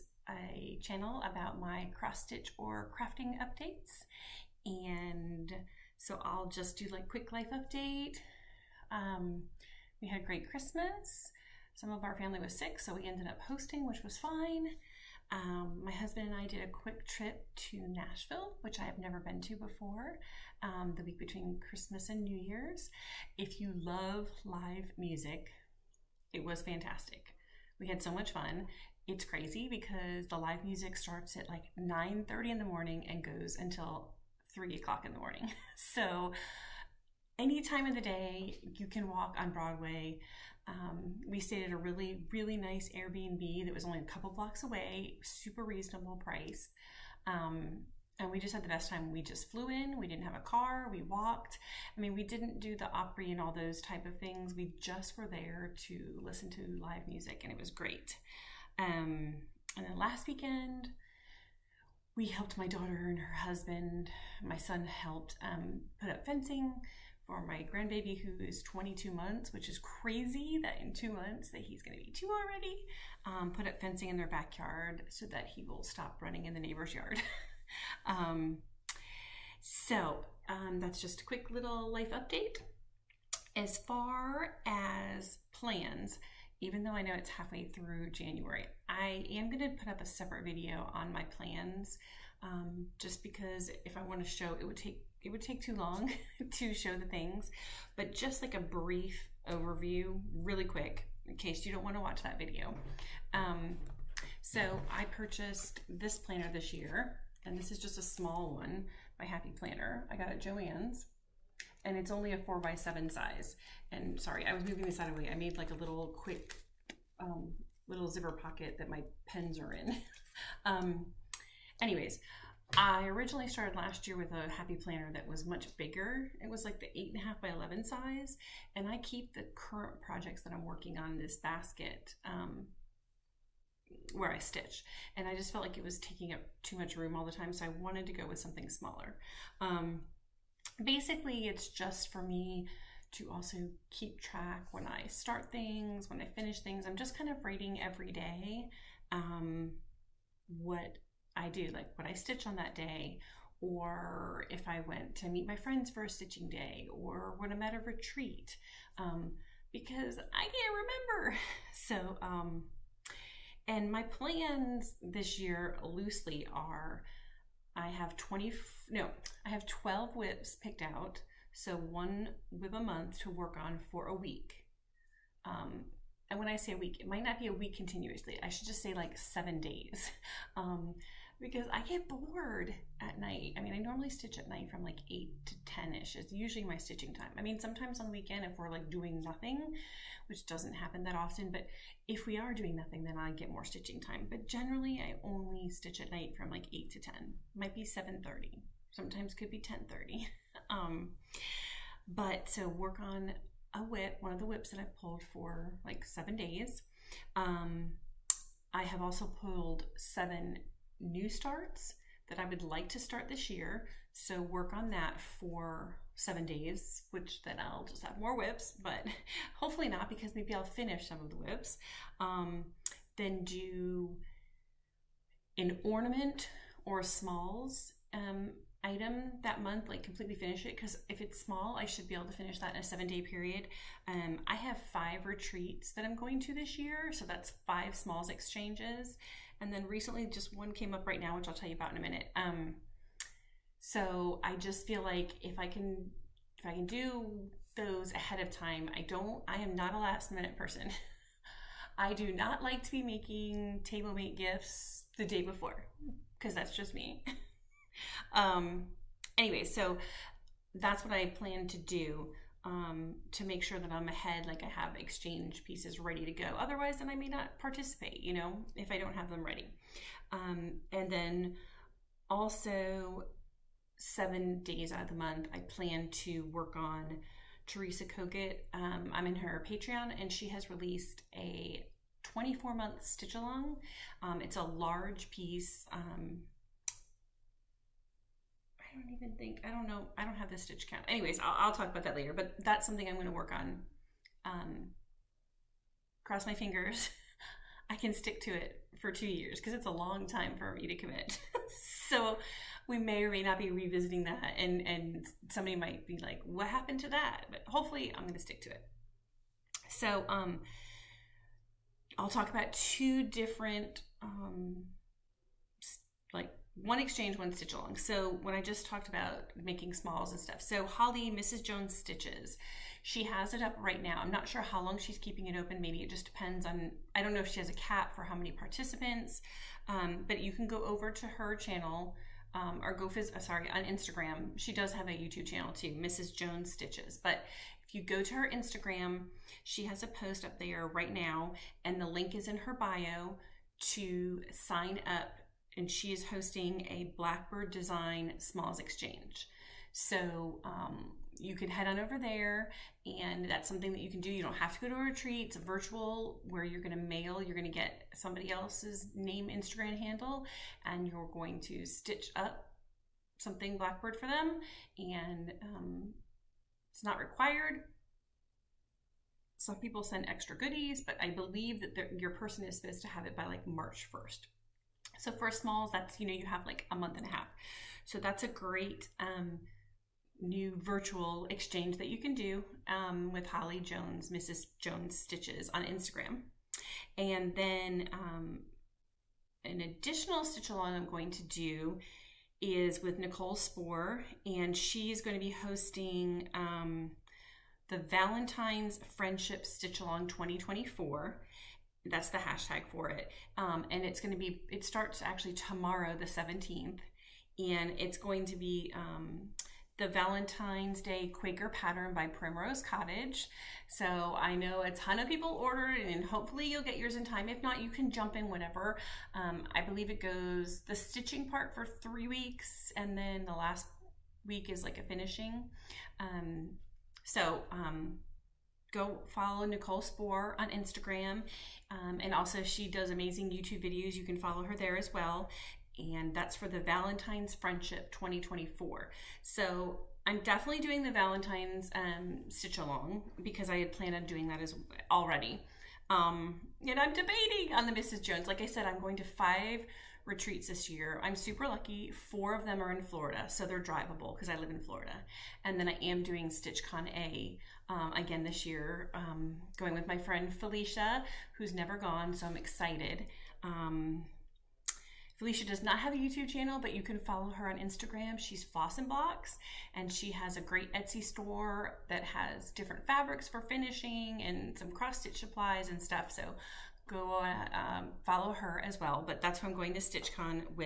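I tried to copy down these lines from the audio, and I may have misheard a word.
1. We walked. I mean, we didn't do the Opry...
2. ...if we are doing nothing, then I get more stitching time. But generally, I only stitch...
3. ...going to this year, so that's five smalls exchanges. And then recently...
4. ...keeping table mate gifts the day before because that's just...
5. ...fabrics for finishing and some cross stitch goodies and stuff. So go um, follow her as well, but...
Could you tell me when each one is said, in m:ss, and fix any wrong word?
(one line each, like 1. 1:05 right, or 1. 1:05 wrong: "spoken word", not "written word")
1. 0:50 right
2. 3:12 right
3. 3:56 right
4. 4:13 wrong: "making", not "keeping"
5. 7:53 wrong: "supplies", not "goodies".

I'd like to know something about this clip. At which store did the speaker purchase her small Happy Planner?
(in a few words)
Joann's.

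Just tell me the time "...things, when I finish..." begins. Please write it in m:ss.
2:25.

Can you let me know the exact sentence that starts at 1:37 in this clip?
But just like a brief overview, really quick, in case you don't want to watch that video.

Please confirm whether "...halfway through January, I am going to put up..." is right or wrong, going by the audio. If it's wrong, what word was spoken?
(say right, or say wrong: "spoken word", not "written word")
right.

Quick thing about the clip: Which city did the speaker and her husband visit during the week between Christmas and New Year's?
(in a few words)
Nashville.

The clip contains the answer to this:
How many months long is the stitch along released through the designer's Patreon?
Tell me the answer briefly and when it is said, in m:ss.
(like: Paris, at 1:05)
24, at 4:42.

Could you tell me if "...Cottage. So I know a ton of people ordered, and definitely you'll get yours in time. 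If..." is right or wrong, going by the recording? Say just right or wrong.
wrong.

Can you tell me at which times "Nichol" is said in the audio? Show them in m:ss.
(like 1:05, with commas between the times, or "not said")
6:33, 7:09.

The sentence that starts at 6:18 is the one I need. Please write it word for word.
So that's a great um, new virtual exchange that you can do um, with Holly Jones, Mrs.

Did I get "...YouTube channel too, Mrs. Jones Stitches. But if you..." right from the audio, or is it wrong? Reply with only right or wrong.
right.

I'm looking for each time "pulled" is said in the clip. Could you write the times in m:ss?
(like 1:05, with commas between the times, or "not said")
3:24, 3:29.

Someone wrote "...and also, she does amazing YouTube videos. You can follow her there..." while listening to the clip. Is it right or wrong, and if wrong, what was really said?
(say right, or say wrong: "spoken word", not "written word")
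right.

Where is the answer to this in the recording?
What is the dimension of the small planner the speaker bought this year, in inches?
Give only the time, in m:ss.
1:52.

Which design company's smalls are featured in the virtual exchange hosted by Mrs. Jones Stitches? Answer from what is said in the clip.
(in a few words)
Blackbird Design.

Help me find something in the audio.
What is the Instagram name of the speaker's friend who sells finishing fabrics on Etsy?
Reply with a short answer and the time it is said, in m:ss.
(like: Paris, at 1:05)
Floss and Blocks, at 7:48.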